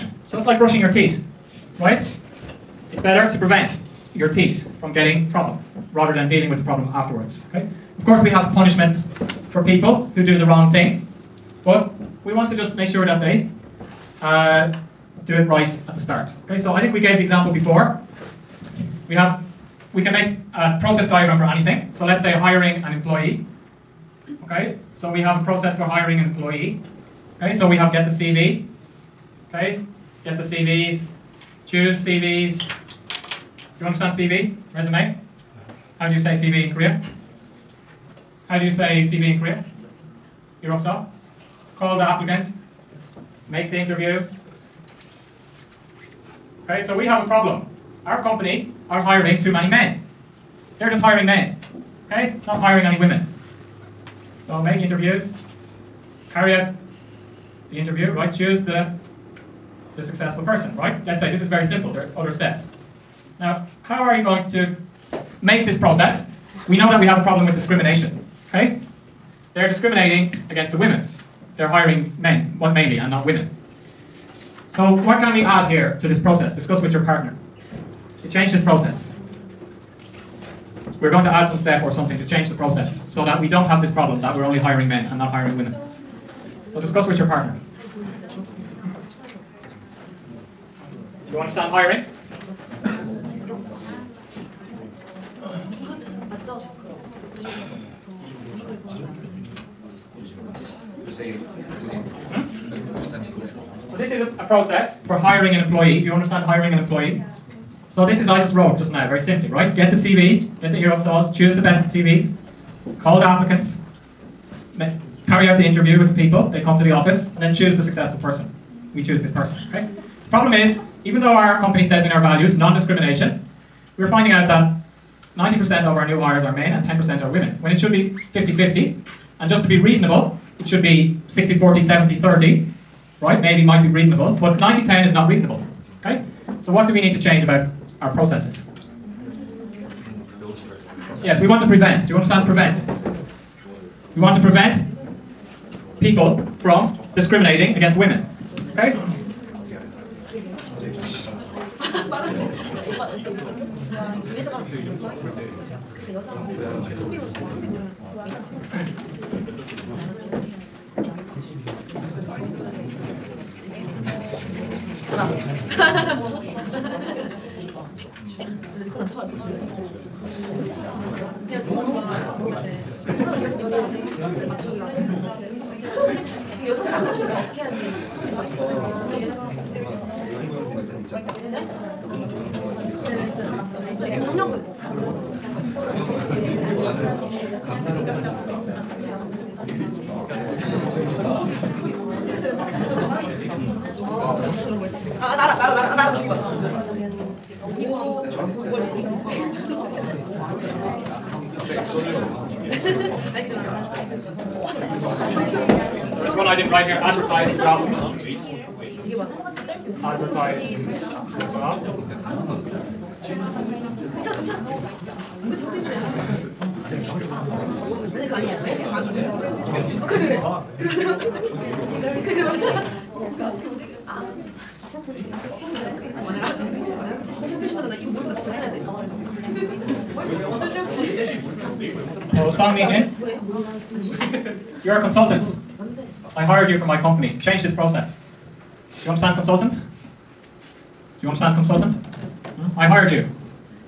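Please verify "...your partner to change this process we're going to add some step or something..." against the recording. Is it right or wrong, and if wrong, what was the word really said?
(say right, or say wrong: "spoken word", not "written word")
right.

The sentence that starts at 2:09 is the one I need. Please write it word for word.
And just to be reasonable, it should be 60-40, 70-30, right?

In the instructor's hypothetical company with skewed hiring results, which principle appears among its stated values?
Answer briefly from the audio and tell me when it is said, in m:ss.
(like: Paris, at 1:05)
non-discrimination, at 2:02.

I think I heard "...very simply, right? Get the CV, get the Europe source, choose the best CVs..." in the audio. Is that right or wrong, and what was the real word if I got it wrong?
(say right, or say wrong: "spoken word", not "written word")
right.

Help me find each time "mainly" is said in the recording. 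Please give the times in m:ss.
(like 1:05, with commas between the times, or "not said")
1:12.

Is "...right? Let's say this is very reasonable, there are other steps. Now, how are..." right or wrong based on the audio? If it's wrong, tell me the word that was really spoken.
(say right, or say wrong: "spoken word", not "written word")
wrong: "simple", not "reasonable".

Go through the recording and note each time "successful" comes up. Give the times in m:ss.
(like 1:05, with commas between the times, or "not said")
1:00, 1:57.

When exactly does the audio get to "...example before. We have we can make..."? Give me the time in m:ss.
0:17.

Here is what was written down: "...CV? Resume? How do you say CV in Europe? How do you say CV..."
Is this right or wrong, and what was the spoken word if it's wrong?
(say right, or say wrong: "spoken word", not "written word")
wrong: "Korea", not "Europe".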